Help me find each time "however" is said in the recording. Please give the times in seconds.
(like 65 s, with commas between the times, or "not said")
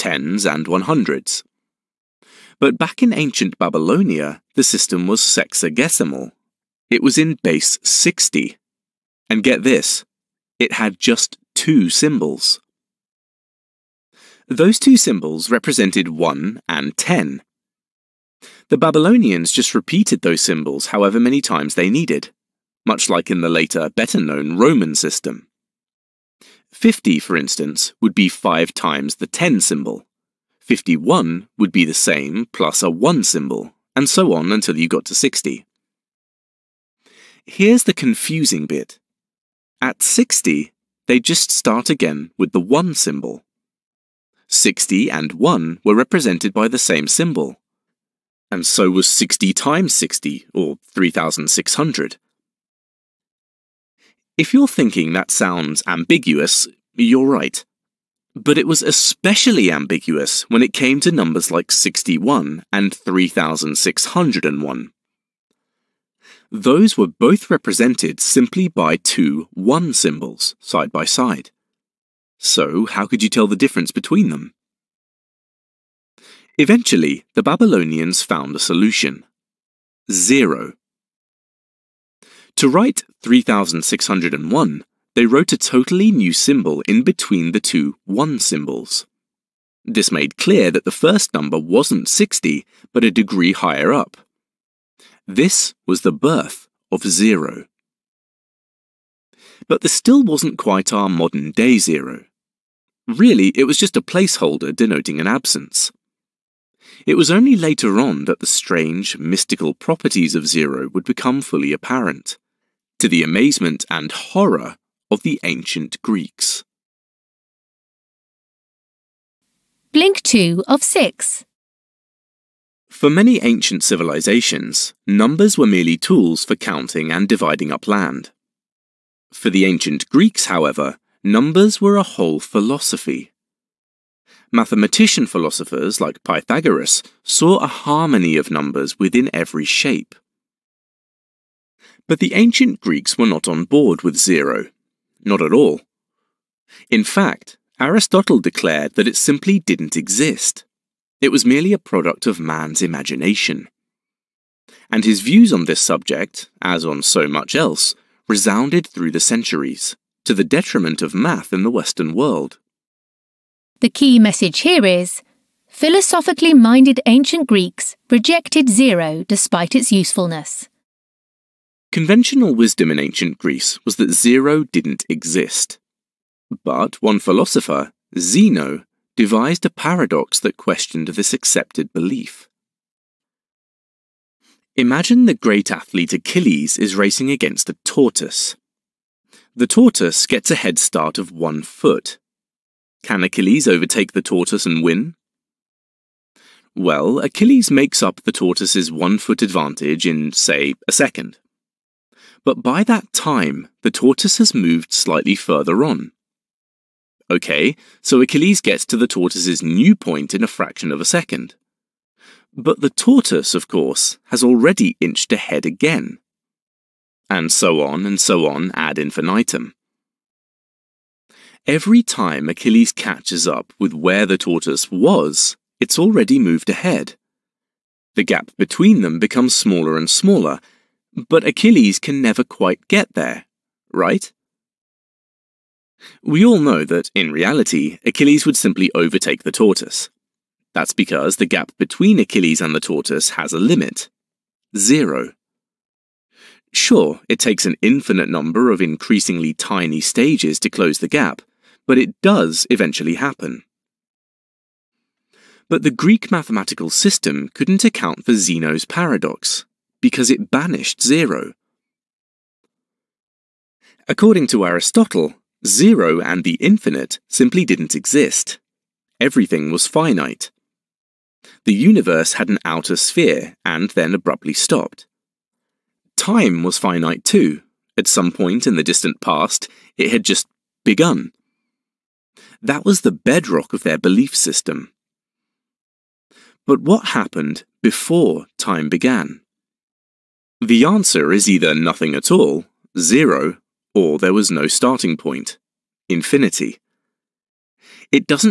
20 s, 130 s.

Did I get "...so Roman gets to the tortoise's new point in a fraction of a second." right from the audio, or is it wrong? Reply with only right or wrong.
wrong.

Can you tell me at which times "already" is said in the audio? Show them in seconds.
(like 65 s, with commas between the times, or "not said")
214 s, 225 s.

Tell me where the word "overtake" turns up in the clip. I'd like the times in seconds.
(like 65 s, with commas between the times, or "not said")
193 s, 238 s.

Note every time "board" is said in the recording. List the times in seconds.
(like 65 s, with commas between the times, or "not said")
143 s.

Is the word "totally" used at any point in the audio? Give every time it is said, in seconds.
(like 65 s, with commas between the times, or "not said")
85 s.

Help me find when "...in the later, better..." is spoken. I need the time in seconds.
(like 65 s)
23 s.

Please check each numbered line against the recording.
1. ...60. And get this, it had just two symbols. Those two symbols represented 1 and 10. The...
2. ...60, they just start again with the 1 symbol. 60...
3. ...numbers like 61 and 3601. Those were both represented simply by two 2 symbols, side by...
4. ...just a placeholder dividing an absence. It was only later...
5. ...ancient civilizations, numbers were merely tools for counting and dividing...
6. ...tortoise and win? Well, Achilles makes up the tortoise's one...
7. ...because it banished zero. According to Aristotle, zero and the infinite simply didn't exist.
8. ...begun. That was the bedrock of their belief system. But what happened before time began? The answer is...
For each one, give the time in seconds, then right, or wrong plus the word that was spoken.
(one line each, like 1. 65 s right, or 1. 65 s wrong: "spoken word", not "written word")
1. 7 s right
2. 40 s right
3. 61 s wrong: "1", not "2"
4. 103 s wrong: "denoting", not "dividing"
5. 123 s right
6. 194 s right
7. 260 s right
8. 280 s right.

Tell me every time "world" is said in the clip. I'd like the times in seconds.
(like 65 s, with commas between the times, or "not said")
162 s.